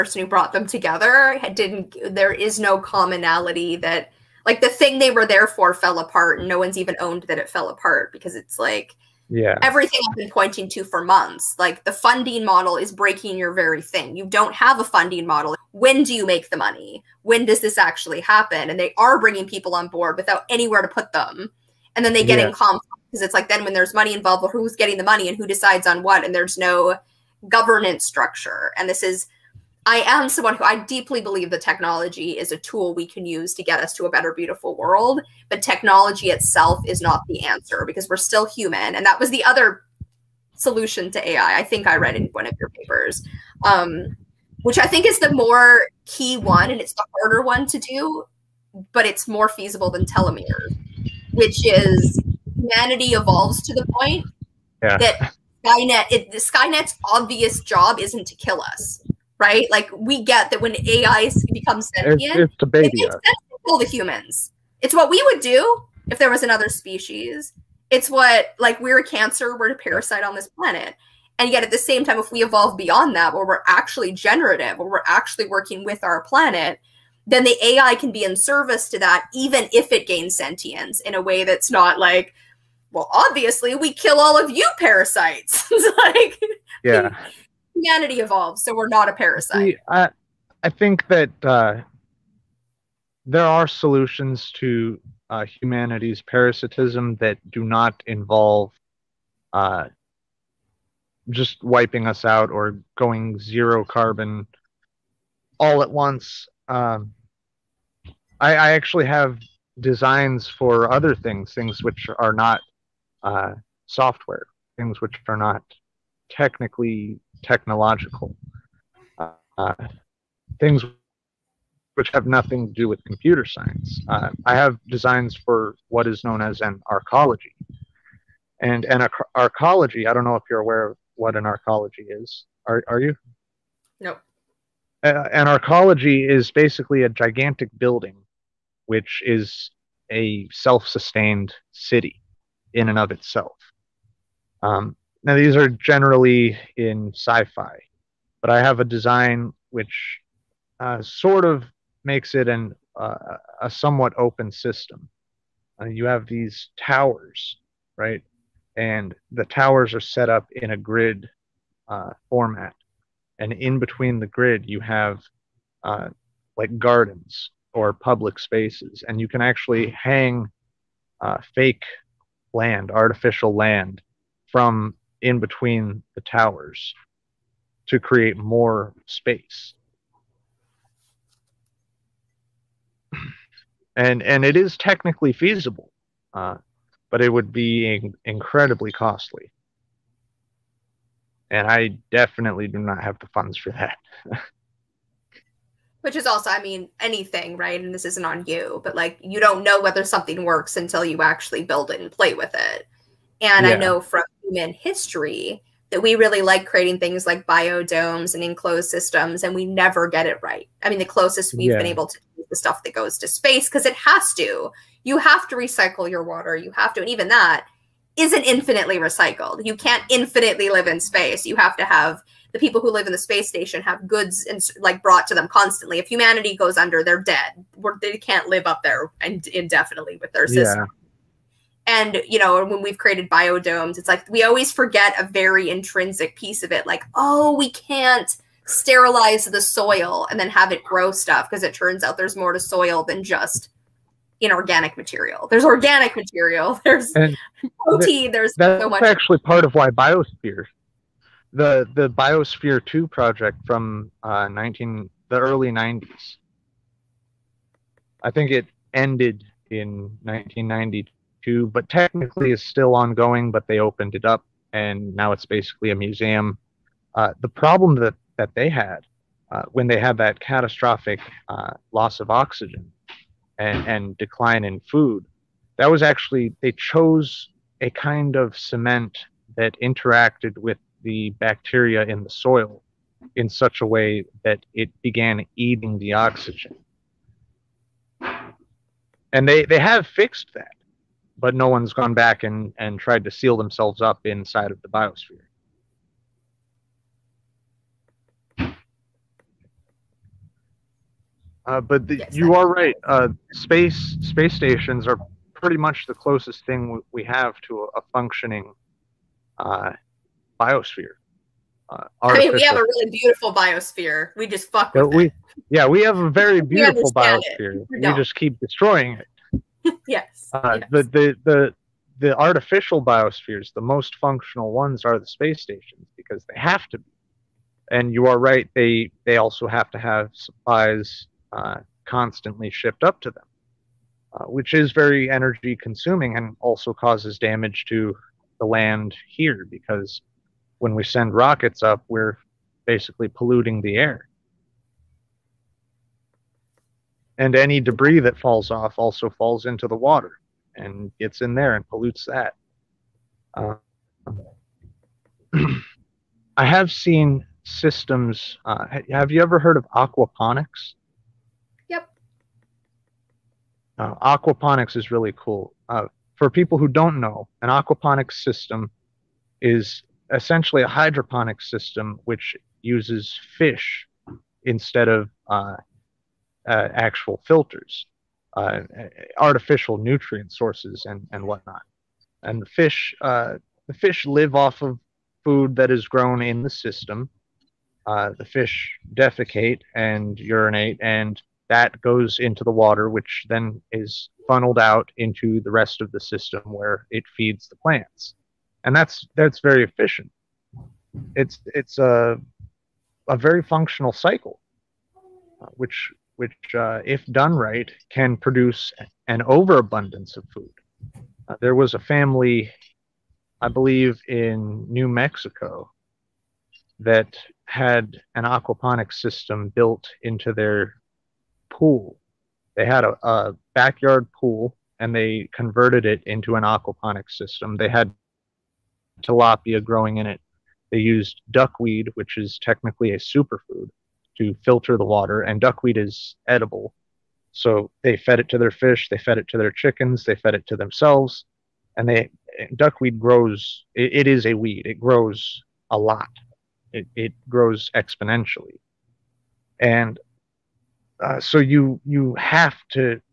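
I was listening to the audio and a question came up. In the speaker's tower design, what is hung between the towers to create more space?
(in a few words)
Artificial land.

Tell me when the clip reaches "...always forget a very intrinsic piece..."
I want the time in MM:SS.
03:54.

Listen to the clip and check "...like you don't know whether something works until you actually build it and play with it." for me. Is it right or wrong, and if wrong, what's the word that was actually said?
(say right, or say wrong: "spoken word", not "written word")
right.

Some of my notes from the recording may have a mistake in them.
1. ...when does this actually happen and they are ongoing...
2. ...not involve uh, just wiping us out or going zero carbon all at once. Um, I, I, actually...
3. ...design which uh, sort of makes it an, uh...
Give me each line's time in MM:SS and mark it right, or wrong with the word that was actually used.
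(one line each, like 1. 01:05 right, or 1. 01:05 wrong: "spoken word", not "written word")
1. 00:17 wrong: "bringing", not "ongoing"
2. 01:37 right
3. 02:28 right.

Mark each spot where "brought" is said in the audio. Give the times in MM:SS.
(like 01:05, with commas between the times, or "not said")
00:00, 03:45.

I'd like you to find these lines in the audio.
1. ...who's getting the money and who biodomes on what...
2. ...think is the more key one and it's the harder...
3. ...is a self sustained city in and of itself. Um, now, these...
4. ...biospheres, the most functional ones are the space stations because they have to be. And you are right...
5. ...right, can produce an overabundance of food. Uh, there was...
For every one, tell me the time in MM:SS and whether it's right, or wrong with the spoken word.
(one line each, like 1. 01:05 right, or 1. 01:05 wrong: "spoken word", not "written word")
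1. 00:24 wrong: "decides", not "biodomes"
2. 00:44 right
3. 02:19 right
4. 05:23 right
5. 06:47 right.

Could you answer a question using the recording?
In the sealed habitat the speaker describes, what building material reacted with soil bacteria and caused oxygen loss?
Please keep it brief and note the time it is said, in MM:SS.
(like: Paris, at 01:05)
Cement, at 04:38.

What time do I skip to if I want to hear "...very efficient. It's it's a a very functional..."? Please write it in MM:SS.
06:39.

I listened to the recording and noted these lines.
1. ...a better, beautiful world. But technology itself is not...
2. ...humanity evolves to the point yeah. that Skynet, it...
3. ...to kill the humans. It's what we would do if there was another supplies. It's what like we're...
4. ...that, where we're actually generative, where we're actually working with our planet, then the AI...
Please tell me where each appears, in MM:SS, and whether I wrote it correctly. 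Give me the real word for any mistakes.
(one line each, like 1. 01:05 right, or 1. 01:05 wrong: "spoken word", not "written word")
1. 00:34 right
2. 00:52 right
3. 01:03 wrong: "species", not "supplies"
4. 01:13 right.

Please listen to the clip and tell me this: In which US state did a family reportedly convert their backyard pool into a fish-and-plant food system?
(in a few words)
New Mexico.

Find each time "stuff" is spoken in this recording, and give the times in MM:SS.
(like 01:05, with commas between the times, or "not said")
03:32, 04:01.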